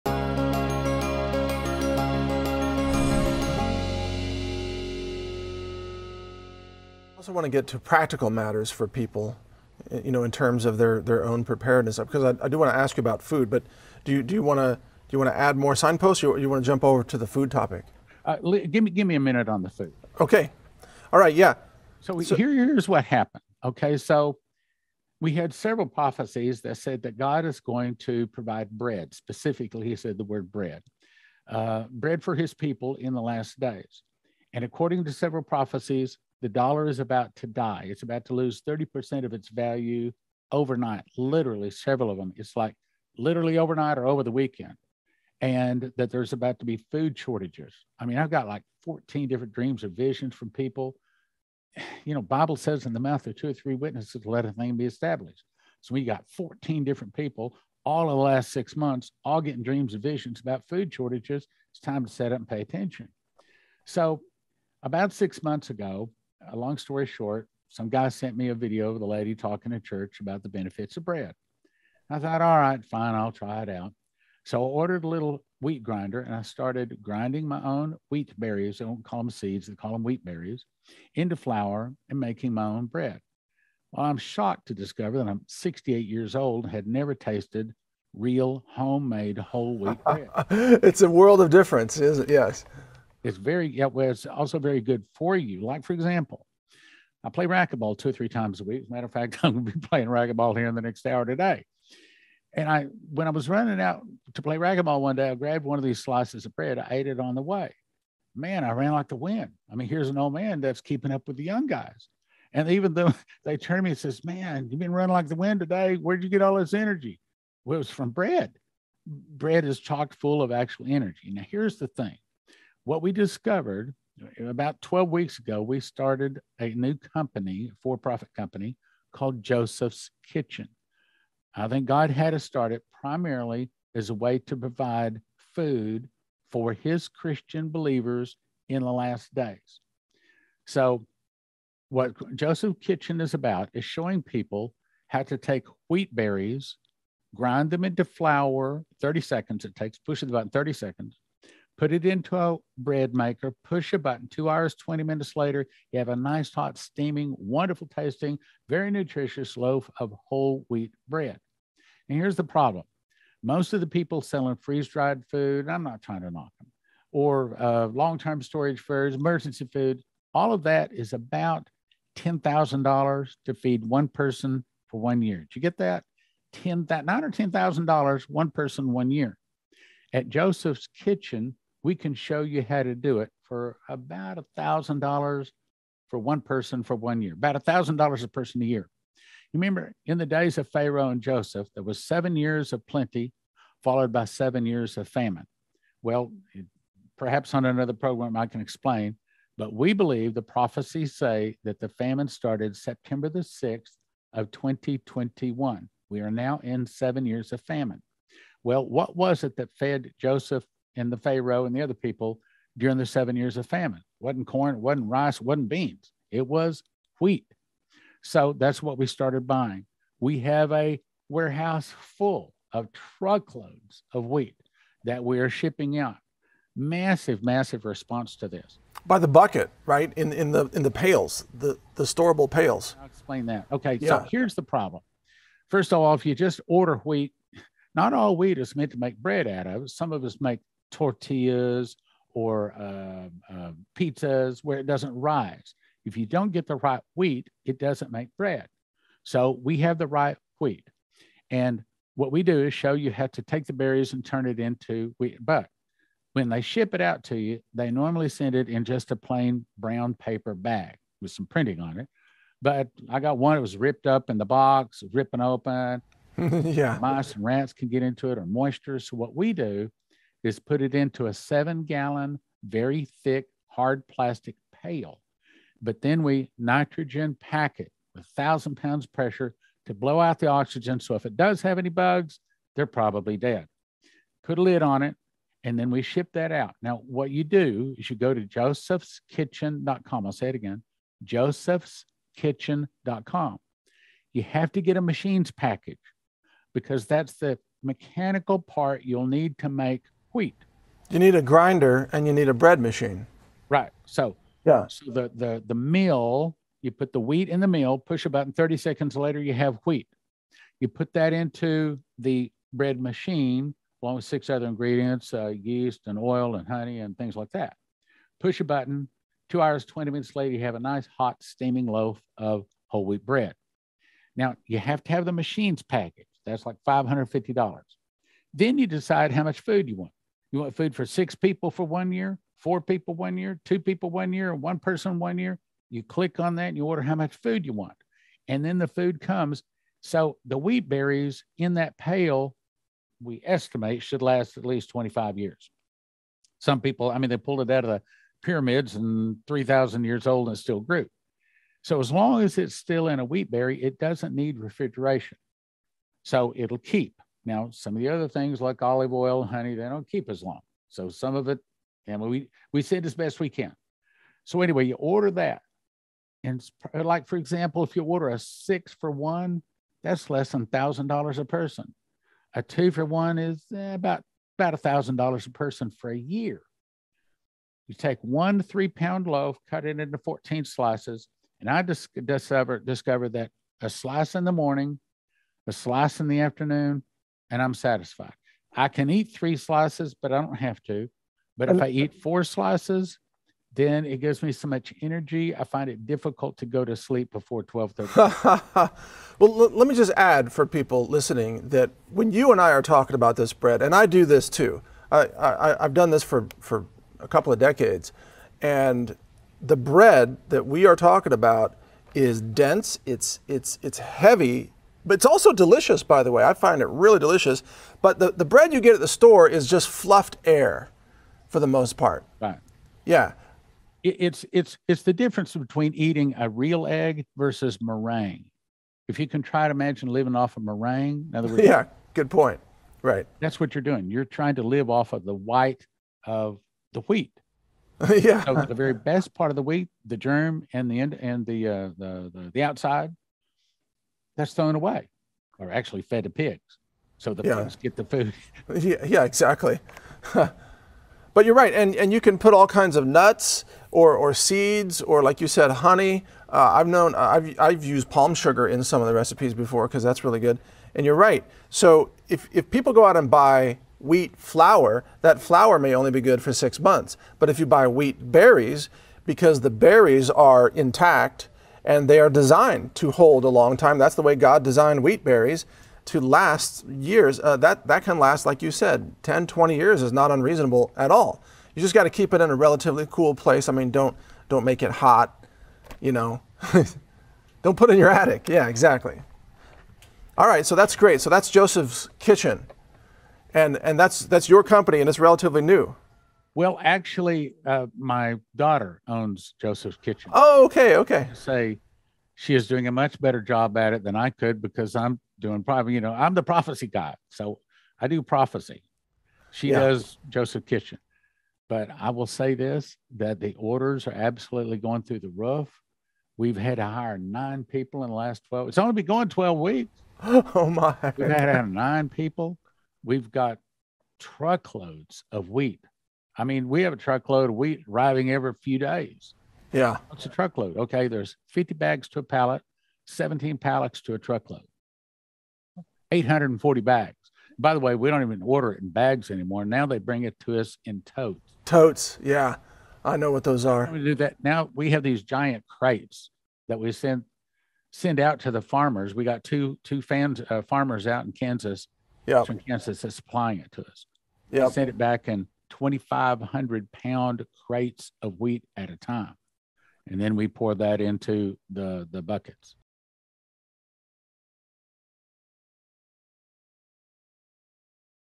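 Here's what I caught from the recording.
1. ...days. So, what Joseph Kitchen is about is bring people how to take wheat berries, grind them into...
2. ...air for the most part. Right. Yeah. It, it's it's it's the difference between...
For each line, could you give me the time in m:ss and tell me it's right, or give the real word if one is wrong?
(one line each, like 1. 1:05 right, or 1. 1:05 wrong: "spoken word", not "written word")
1. 2:19 wrong: "showing", not "bring"
2. 7:00 right.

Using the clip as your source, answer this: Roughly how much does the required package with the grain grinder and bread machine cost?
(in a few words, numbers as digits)
$550.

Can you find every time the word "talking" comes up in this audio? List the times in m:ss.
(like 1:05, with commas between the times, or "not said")
1:09, 6:42, 6:50.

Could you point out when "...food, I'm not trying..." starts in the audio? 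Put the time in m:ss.
2:45.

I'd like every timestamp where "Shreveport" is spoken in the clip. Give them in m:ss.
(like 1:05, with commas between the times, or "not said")
not said.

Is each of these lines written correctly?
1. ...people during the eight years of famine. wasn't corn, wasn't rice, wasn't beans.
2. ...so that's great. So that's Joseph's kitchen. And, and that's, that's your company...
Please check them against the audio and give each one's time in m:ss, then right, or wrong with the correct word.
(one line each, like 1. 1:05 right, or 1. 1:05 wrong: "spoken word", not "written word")
1. 3:31 wrong: "seven", not "eight"
2. 8:10 right.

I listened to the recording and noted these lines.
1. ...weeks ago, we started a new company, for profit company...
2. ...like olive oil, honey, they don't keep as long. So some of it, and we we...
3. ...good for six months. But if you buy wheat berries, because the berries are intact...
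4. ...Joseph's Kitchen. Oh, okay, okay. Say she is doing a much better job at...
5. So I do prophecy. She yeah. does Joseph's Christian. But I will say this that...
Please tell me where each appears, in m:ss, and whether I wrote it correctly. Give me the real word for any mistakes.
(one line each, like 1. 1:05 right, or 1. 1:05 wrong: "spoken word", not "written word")
1. 2:05 right
2. 5:58 right
3. 7:46 right
4. 8:19 right
5. 8:27 wrong: "Kitchen", not "Christian".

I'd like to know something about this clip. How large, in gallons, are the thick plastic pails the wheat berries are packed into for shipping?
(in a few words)
7 gallons.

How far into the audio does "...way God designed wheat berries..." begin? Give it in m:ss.
7:54.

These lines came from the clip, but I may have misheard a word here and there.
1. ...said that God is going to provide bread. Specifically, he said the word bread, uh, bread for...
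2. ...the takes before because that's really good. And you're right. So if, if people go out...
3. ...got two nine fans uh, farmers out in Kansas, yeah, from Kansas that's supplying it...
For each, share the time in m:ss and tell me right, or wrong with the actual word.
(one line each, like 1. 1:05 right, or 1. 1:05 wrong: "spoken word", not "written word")
1. 0:26 right
2. 7:39 wrong: "recipes", not "takes"
3. 9:09 wrong: "two", not "nine".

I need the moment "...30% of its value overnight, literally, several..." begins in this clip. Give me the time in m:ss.
0:38.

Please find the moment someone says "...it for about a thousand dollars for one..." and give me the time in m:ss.
3:03.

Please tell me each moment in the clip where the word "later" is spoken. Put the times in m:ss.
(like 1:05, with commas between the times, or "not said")
2:35, 5:09, 5:20.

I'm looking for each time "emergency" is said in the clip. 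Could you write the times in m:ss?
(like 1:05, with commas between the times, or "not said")
2:49.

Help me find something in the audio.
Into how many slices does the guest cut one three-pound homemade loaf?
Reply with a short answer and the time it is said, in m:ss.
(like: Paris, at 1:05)
14, at 6:20.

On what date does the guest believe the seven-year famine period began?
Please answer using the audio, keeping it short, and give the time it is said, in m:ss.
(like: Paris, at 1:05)
September 6, 2021, at 3:22.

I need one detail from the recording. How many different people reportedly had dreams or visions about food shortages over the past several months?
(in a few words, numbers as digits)
14.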